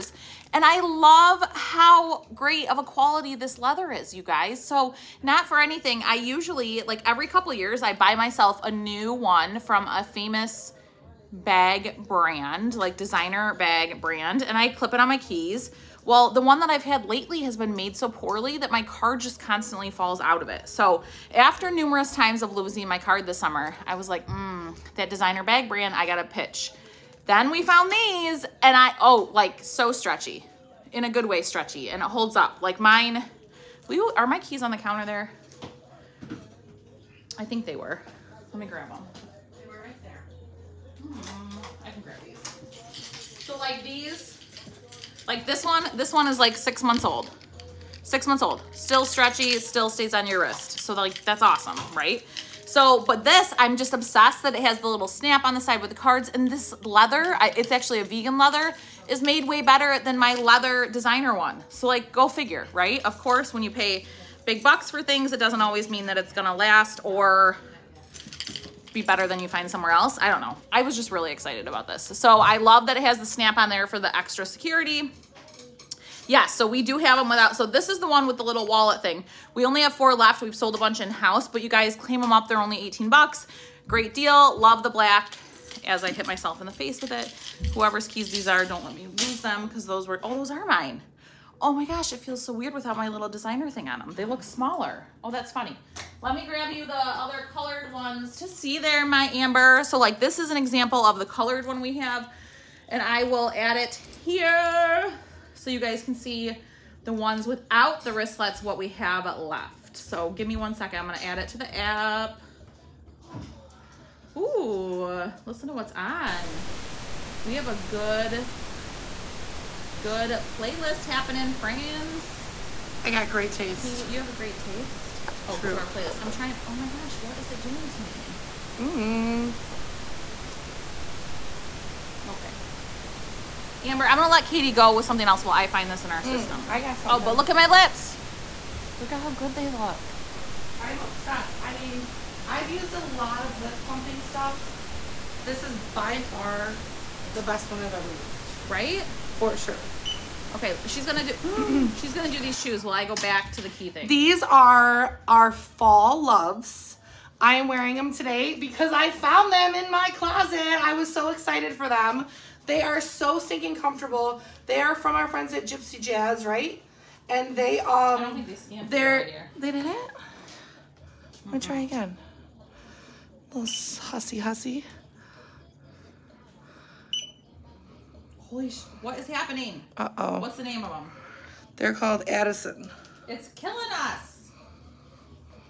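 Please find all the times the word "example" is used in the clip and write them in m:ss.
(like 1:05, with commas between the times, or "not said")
1:40.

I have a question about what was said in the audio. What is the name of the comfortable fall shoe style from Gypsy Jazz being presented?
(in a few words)
Addison.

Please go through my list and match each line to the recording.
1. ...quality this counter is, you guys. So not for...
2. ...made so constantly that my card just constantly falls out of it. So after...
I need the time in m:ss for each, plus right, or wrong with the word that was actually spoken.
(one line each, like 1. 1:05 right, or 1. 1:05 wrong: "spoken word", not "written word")
1. 0:02 wrong: "leather", not "counter"
2. 0:17 wrong: "poorly", not "constantly".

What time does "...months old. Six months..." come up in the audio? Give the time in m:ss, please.
0:46.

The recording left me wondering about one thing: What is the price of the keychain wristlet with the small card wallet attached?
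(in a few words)
18 bucks.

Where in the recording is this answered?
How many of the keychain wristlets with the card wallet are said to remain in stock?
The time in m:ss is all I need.
1:19.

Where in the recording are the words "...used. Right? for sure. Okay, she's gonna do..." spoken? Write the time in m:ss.
2:28.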